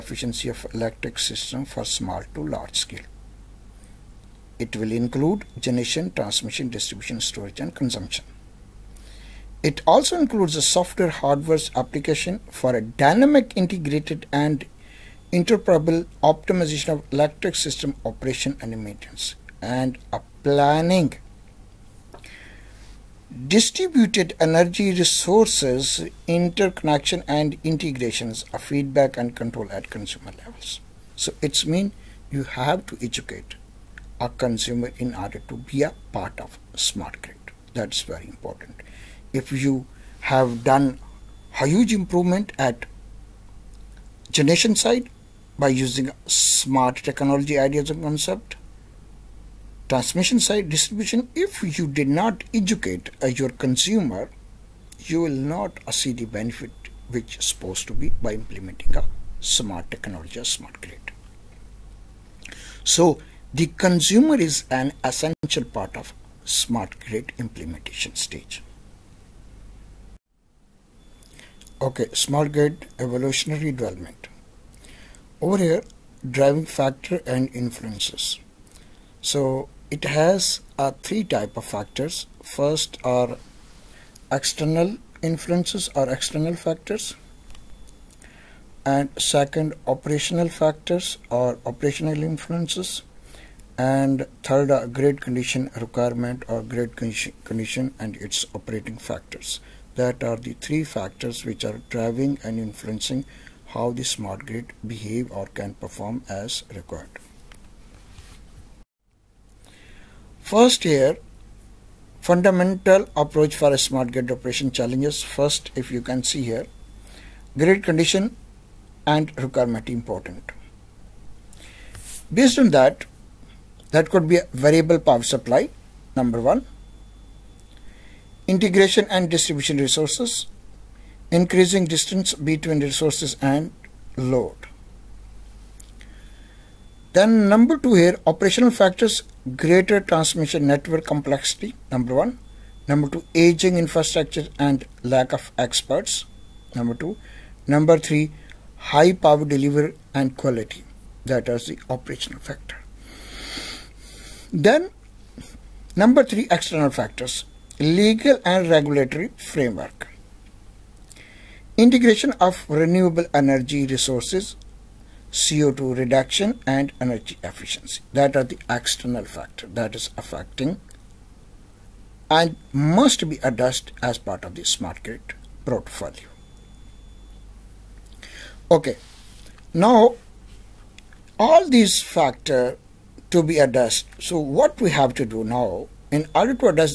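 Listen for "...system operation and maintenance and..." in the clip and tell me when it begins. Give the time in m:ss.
0:17.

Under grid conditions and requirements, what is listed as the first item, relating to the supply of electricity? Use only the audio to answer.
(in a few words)
Variable power supply.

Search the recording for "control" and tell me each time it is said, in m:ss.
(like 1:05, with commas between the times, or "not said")
0:29.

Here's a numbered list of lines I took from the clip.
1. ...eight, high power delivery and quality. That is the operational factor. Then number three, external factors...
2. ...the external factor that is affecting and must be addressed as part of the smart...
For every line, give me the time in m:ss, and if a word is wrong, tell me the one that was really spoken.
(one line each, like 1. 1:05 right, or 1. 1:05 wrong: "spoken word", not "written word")
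1. 2:27 wrong: "three", not "eight"
2. 2:48 right.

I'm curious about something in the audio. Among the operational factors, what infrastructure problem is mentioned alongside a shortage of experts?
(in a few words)
Aging infrastructure.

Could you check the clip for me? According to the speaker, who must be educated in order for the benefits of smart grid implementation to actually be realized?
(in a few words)
The consumer.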